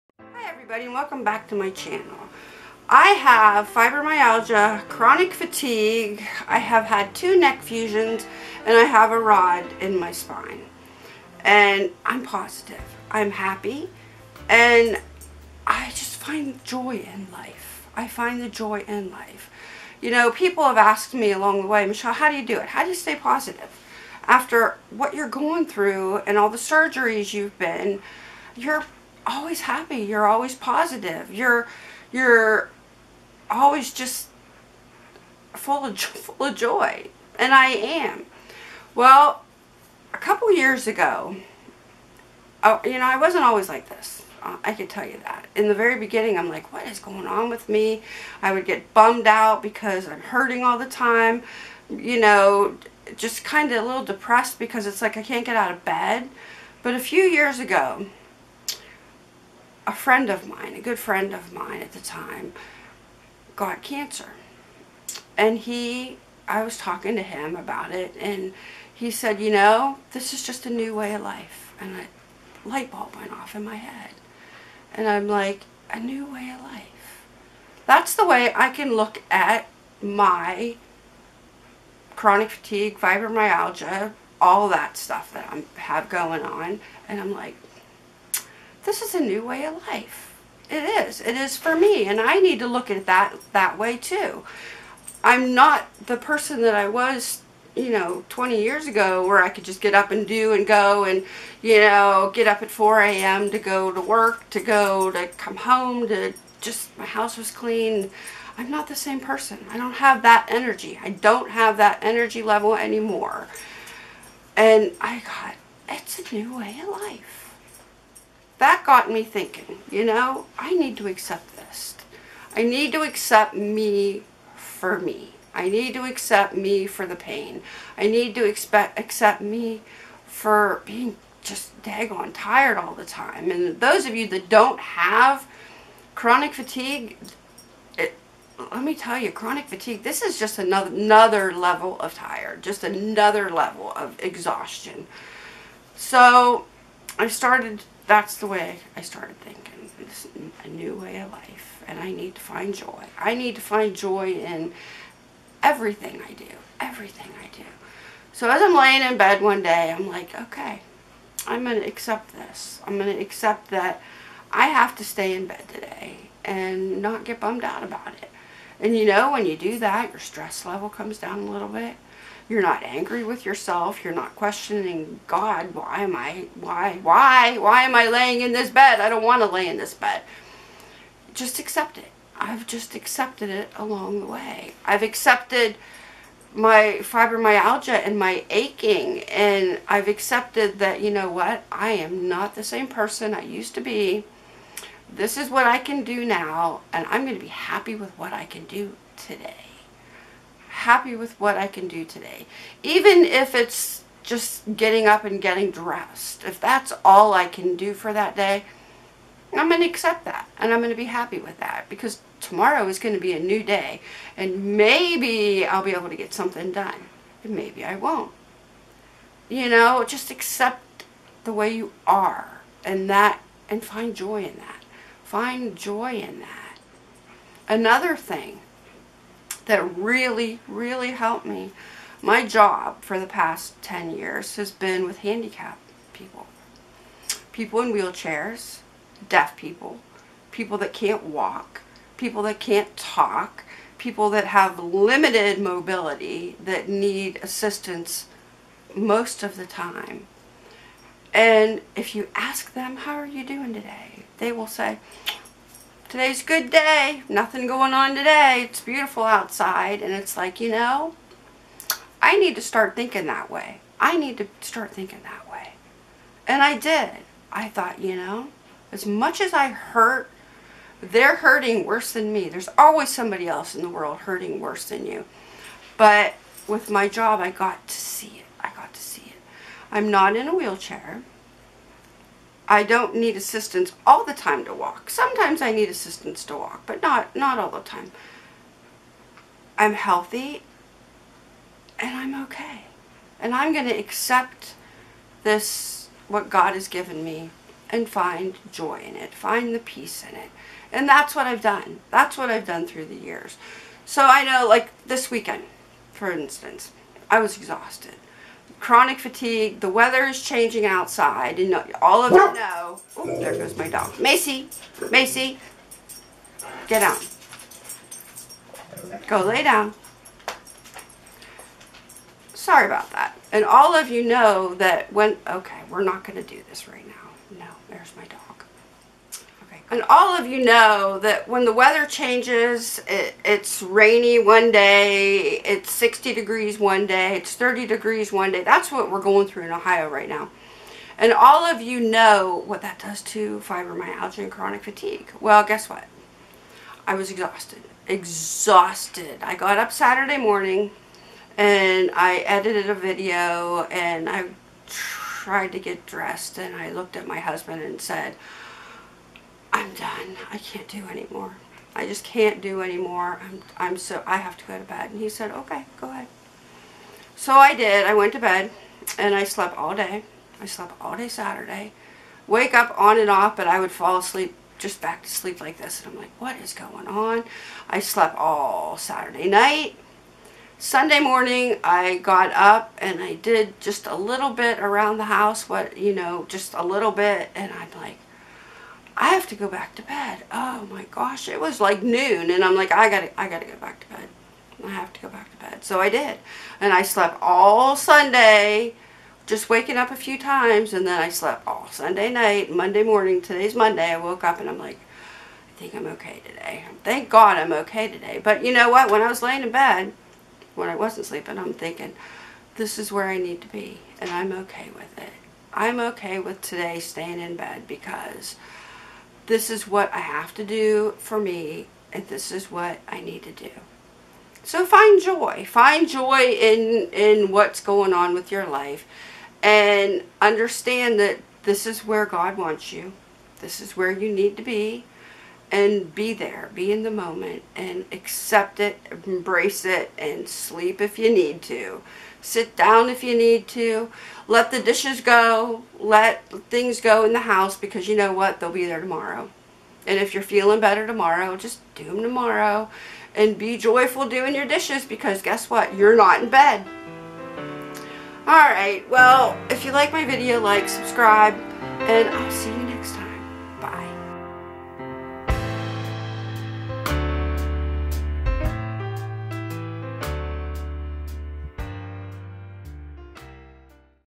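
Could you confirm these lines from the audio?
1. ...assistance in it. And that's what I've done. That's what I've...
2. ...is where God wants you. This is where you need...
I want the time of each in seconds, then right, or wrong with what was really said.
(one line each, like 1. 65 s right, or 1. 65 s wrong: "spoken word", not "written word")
1. 299 s wrong: "peace", not "assistance"
2. 431 s right.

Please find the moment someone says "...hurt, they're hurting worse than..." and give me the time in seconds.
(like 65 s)
269 s.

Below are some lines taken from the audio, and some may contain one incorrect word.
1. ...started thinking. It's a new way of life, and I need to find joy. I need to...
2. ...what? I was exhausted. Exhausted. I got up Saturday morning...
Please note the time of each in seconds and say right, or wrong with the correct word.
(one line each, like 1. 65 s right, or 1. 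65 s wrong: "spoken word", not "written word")
1. 149 s right
2. 345 s right.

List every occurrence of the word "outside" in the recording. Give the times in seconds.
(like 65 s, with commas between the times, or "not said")
259 s, 310 s.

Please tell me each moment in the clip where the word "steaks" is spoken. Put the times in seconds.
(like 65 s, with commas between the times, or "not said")
not said.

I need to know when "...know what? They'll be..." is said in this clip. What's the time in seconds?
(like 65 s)
448 s.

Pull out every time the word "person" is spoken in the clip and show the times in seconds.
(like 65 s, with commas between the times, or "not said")
96 s, 109 s, 192 s.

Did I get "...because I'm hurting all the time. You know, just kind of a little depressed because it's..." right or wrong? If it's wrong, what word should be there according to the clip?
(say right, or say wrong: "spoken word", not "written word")
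right.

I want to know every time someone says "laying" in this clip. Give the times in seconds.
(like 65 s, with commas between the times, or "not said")
158 s, 178 s, 409 s.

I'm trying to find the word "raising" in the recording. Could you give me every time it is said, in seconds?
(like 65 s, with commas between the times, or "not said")
not said.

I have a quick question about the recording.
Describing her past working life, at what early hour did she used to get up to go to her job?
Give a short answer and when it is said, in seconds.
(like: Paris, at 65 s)
4 a.m., at 102 s.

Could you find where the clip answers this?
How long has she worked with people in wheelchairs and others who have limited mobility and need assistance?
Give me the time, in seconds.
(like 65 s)
233 s.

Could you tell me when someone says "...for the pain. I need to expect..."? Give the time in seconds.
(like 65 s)
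126 s.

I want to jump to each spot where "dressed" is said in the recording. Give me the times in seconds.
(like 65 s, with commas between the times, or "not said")
205 s, 356 s.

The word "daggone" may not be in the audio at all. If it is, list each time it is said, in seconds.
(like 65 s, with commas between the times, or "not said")
131 s.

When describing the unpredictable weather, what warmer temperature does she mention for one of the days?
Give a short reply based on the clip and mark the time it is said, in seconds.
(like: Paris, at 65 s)
60 degrees, at 335 s.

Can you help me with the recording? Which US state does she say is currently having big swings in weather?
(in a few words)
Ohio.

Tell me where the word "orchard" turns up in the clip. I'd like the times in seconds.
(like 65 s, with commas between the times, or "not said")
not said.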